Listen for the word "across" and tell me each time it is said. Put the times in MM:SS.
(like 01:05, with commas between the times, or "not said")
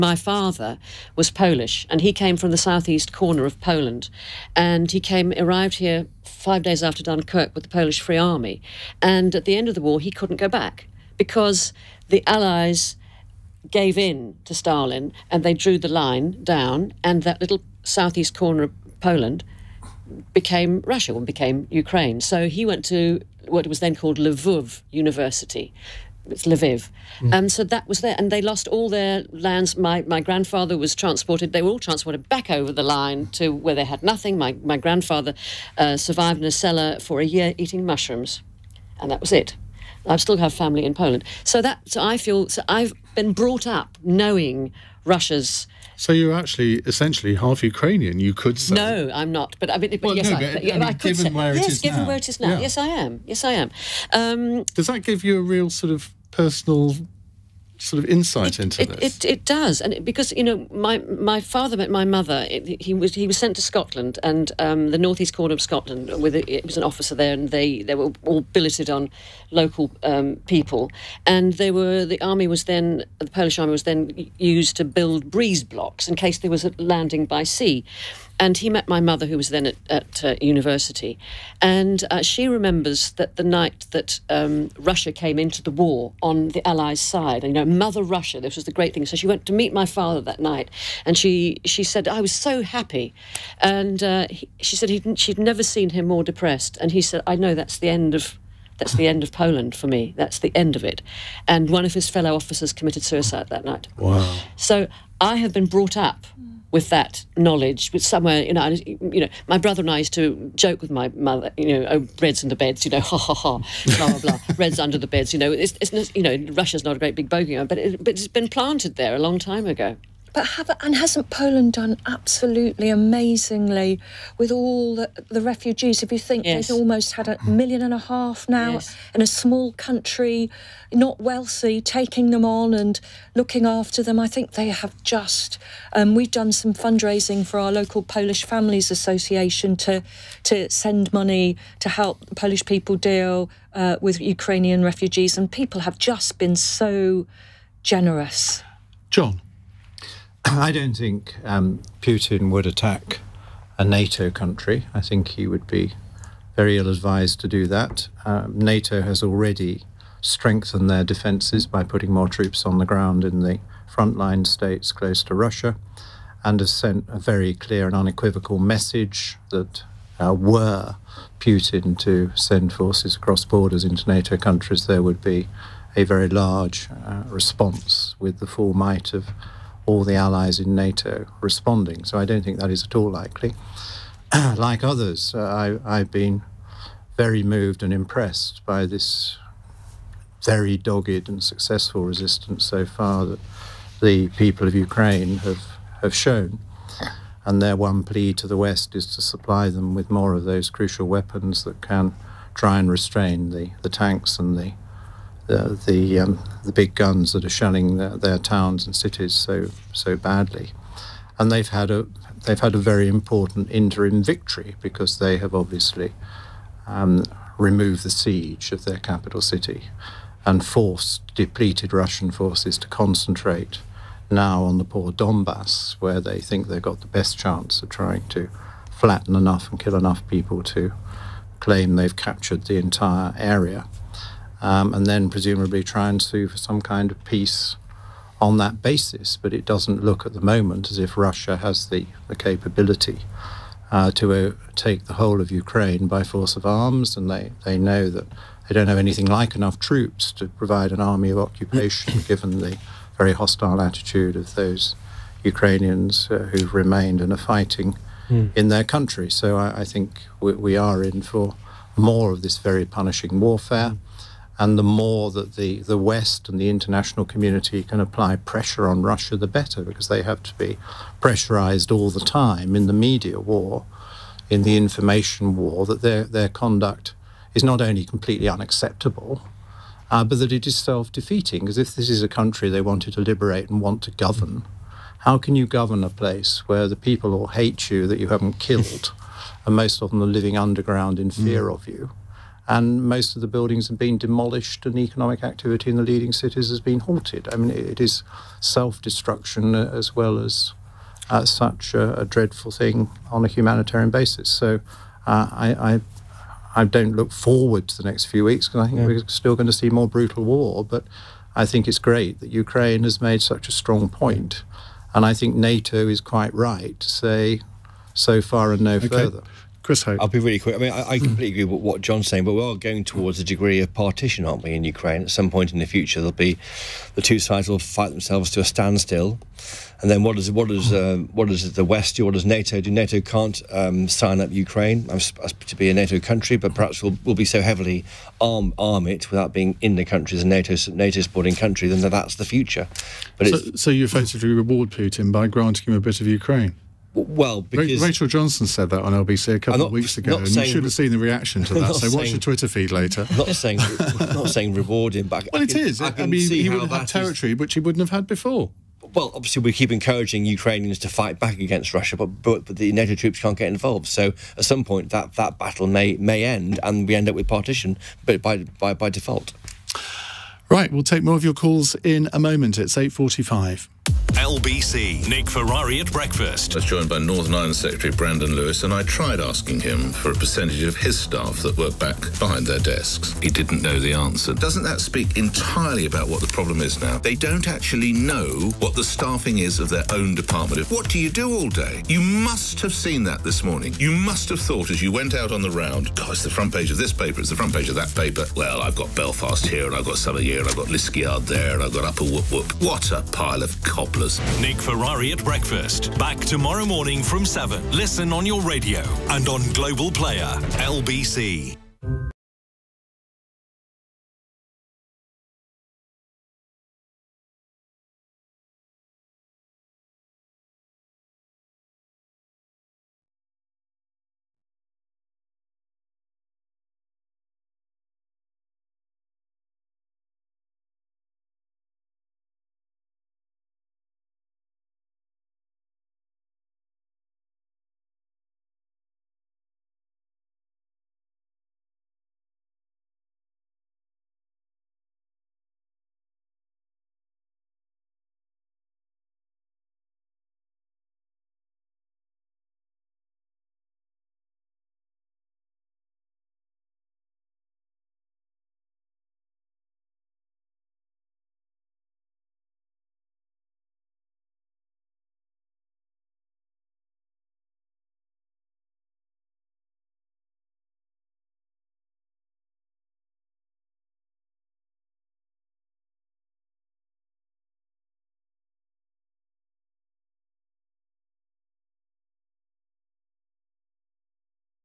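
02:53.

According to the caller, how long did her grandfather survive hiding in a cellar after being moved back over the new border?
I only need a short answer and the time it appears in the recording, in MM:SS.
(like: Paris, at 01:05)
a year, at 00:37.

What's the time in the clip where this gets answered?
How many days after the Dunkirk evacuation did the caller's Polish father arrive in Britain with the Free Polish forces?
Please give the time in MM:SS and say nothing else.
00:06.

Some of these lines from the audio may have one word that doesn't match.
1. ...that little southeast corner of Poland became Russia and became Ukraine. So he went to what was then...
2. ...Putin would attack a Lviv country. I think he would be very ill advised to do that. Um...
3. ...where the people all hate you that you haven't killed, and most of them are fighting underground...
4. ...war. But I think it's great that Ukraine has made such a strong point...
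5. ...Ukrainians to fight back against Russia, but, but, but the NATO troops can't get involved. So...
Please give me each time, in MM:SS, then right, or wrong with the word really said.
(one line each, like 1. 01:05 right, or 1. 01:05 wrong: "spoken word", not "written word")
1. 00:17 right
2. 02:32 wrong: "NATO", not "Lviv"
3. 04:46 wrong: "living", not "fighting"
4. 05:10 right
5. 06:00 right.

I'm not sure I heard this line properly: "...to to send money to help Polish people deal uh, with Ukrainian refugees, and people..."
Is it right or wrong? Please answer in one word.
right.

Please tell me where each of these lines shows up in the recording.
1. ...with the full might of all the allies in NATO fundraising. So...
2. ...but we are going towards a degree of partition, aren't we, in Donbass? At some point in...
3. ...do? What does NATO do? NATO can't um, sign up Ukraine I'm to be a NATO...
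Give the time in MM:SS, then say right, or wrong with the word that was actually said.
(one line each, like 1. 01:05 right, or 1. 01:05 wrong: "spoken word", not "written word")
1. 02:58 wrong: "responding", not "fundraising"
2. 05:22 wrong: "Ukraine", not "Donbass"
3. 05:32 right.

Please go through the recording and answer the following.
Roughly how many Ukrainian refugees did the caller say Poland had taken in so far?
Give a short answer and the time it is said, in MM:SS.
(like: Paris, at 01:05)
a million and a half, at 02:07.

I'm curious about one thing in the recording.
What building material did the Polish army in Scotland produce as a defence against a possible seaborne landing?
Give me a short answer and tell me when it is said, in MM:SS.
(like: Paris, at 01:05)
breeze blocks, at 01:15.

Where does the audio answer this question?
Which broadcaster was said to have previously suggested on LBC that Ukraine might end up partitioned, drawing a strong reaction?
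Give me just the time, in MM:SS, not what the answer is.
05:48.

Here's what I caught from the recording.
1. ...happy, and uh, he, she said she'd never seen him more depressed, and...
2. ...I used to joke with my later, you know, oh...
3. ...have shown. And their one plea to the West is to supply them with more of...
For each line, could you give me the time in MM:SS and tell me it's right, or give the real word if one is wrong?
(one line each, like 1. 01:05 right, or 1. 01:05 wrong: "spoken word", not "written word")
1. 01:32 right
2. 01:49 wrong: "mother", not "later"
3. 03:16 right.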